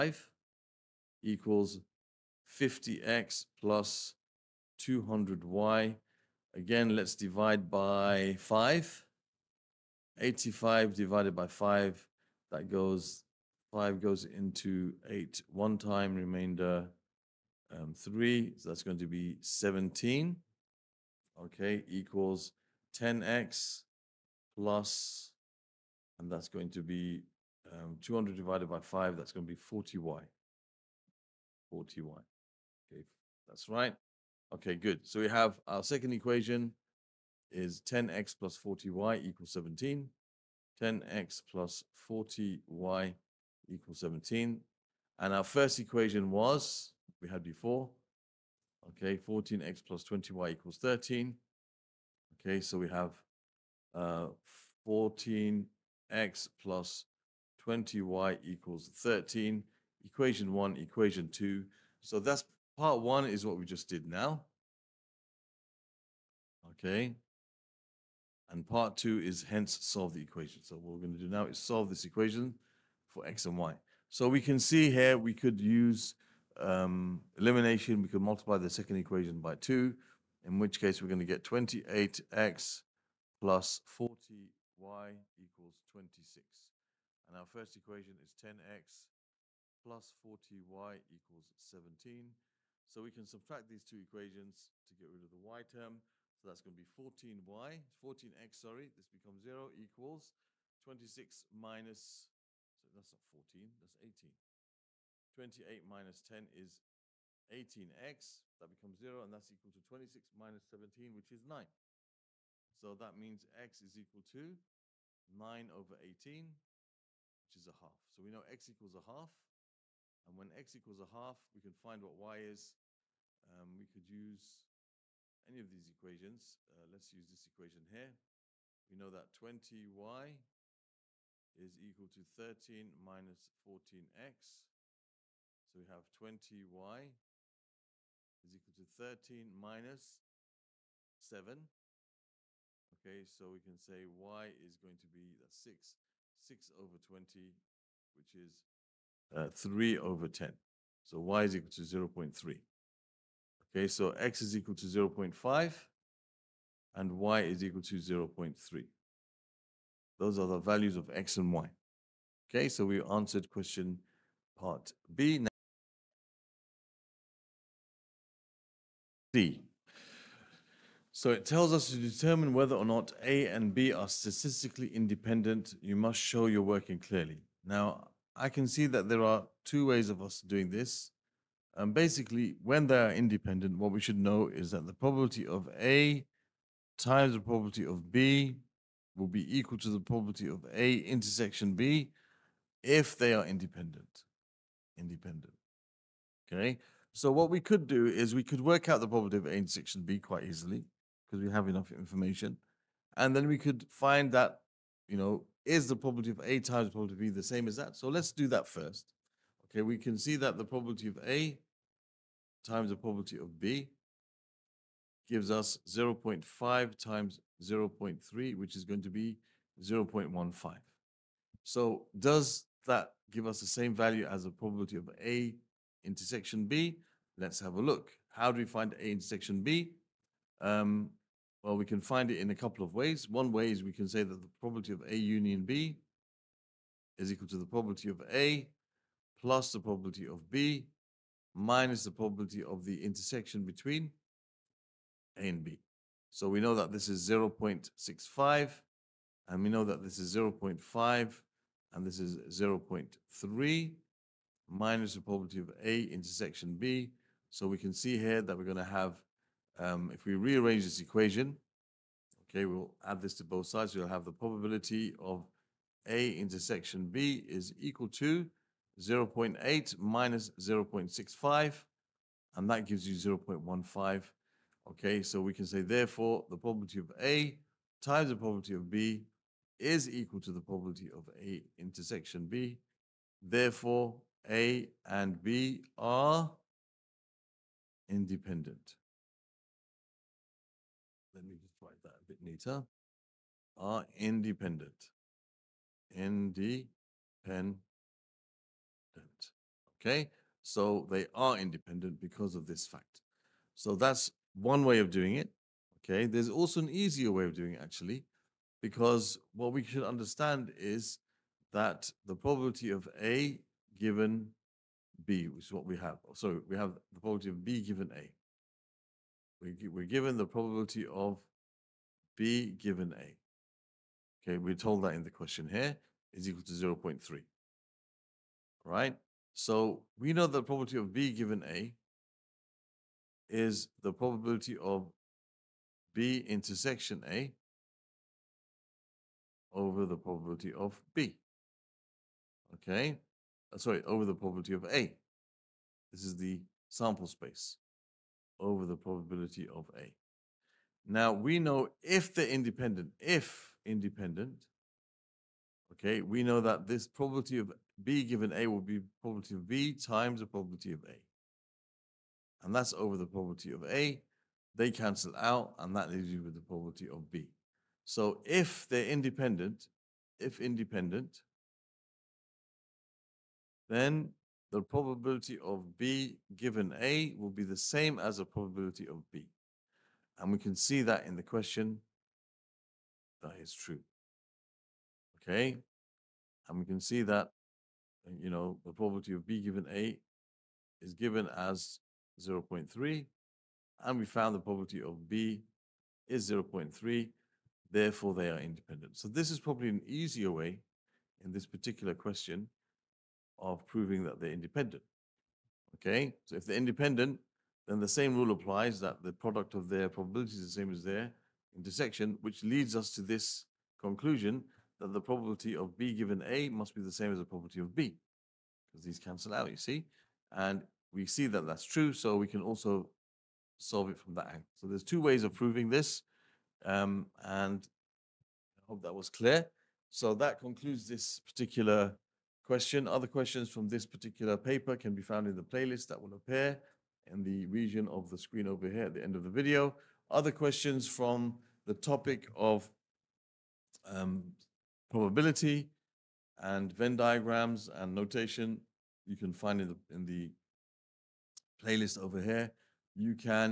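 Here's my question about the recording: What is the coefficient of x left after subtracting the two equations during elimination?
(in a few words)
18.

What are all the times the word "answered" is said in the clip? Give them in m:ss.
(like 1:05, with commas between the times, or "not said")
2:43.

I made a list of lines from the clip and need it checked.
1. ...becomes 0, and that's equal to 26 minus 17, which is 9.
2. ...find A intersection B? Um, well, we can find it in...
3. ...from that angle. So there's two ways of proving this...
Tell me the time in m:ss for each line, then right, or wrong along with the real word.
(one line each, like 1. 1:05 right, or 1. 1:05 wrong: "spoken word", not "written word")
1. 1:48 right
2. 3:48 right
3. 7:04 right.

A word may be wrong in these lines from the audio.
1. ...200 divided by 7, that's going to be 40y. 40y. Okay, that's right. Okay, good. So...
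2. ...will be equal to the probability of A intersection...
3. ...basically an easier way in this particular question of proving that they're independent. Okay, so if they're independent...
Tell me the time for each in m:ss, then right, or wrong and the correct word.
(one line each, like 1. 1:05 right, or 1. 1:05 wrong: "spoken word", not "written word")
1. 0:28 wrong: "5", not "7"
2. 3:09 right
3. 6:39 wrong: "probably", not "basically".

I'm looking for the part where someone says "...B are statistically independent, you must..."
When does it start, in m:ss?
2:53.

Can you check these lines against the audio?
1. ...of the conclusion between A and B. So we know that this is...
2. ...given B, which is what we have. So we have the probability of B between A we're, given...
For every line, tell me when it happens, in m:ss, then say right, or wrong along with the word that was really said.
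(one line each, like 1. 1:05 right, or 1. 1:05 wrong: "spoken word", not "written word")
1. 4:02 wrong: "intersection", not "conclusion"
2. 5:13 wrong: "given", not "between".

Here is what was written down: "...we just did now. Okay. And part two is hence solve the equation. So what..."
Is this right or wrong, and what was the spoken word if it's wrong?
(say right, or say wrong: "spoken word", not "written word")
right.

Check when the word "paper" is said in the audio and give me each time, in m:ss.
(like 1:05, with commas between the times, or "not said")
7:14.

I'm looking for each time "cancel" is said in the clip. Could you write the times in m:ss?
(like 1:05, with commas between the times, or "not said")
6:04, 6:59.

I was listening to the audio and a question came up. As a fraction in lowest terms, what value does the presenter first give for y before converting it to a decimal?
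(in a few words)
3/10.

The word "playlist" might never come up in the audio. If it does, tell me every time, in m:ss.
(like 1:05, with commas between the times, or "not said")
7:15, 7:31.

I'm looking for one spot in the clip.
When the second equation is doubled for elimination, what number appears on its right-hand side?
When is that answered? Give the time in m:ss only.
1:21.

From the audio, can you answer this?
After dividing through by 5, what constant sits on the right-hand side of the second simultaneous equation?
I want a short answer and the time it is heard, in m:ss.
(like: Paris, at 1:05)
17, at 0:18.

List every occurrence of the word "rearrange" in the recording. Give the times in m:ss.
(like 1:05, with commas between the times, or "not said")
4:20.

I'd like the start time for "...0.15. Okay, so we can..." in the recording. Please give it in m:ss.
4:33.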